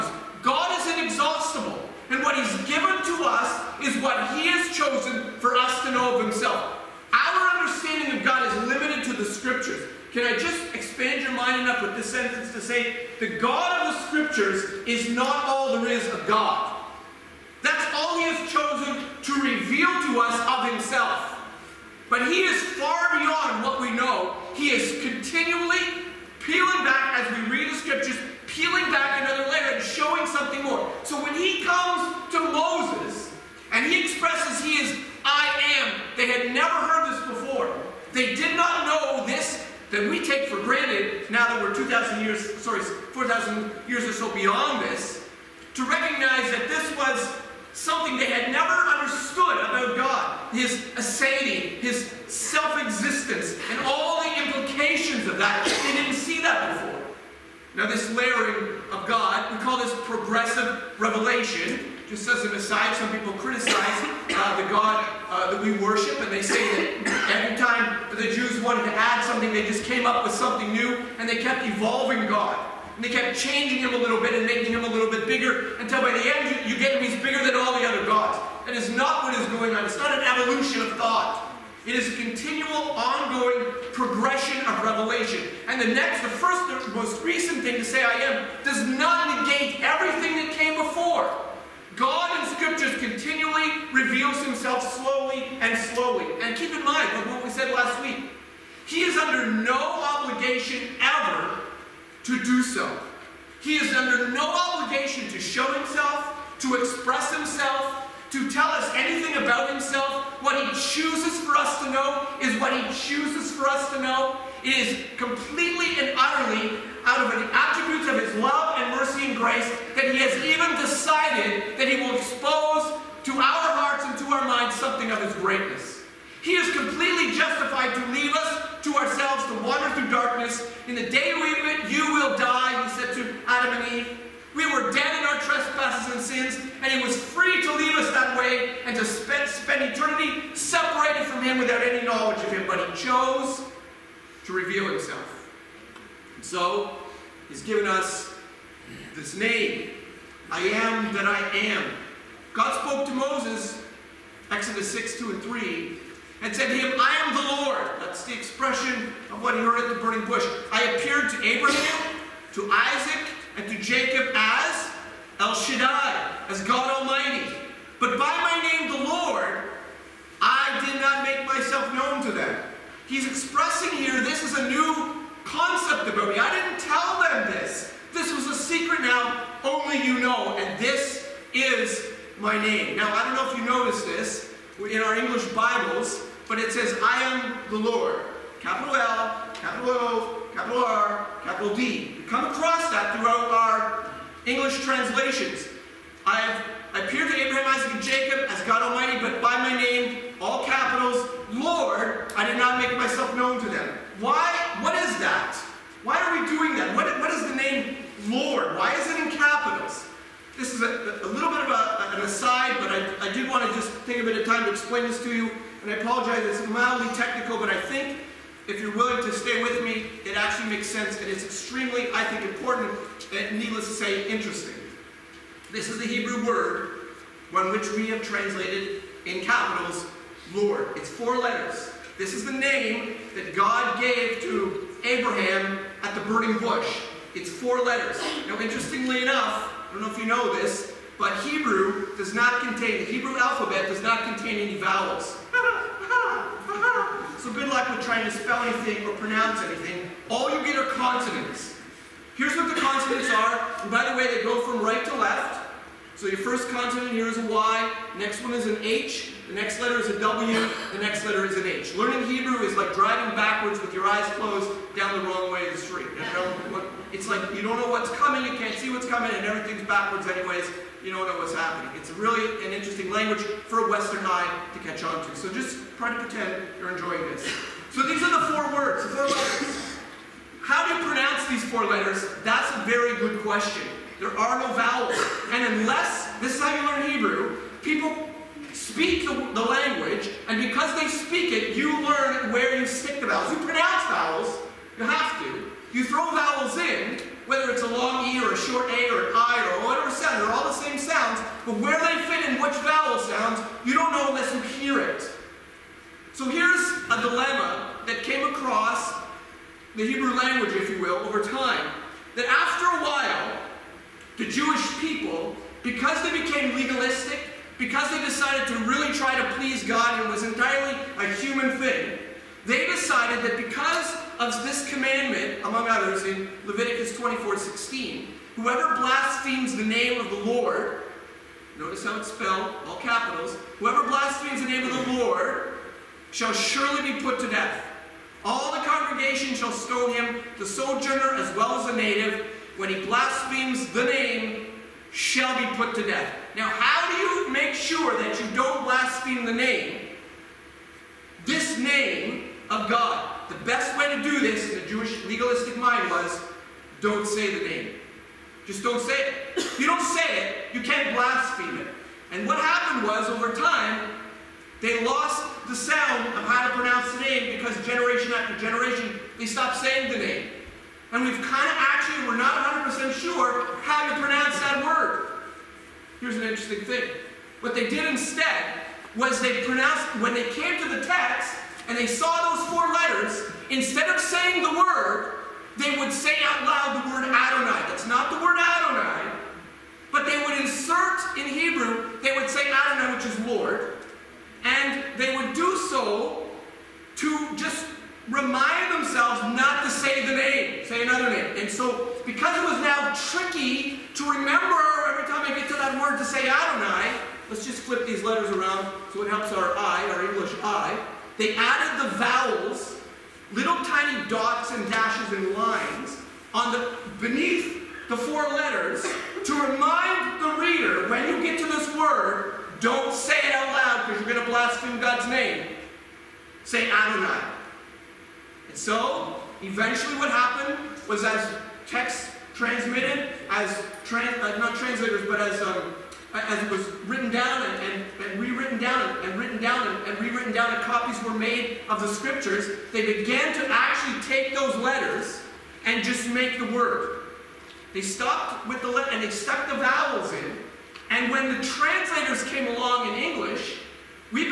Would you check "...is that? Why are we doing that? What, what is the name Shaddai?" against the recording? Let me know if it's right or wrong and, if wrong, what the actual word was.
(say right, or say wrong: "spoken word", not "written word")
wrong: "Lord", not "Shaddai".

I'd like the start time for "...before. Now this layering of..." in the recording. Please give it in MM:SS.
00:56.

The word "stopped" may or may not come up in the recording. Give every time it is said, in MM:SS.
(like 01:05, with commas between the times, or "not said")
06:09, 07:28.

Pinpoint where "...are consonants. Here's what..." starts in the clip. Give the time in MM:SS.
04:10.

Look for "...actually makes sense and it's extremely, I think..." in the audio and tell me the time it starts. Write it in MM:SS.
03:40.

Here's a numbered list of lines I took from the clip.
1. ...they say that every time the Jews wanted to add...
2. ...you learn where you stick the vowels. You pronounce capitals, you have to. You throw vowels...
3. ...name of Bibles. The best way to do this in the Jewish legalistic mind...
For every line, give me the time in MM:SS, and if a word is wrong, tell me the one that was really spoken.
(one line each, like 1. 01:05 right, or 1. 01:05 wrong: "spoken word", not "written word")
1. 01:06 right
2. 04:51 wrong: "vowels", not "capitals"
3. 05:51 wrong: "God", not "Bibles".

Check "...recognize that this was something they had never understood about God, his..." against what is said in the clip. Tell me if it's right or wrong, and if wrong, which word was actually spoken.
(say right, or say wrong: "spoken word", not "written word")
right.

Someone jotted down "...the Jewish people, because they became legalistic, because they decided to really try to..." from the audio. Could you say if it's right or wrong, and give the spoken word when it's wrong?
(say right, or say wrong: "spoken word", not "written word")
right.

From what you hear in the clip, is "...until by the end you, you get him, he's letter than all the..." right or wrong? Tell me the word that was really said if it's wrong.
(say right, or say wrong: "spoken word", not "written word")
wrong: "bigger", not "letter".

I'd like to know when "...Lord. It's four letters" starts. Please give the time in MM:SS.
03:50.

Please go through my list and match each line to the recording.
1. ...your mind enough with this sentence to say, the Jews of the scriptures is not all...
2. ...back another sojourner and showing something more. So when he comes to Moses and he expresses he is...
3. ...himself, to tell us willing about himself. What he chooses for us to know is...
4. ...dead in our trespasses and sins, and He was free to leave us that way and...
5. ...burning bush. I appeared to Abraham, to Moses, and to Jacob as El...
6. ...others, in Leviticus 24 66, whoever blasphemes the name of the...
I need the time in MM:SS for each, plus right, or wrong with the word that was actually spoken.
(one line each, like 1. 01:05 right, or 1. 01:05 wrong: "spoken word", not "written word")
1. 00:11 wrong: "God", not "Jews"
2. 00:28 wrong: "layer", not "sojourner"
3. 01:47 wrong: "anything", not "willing"
4. 02:14 right
5. 02:40 wrong: "Isaac", not "Moses"
6. 05:25 wrong: "16", not "66".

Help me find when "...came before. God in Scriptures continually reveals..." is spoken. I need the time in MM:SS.
01:30.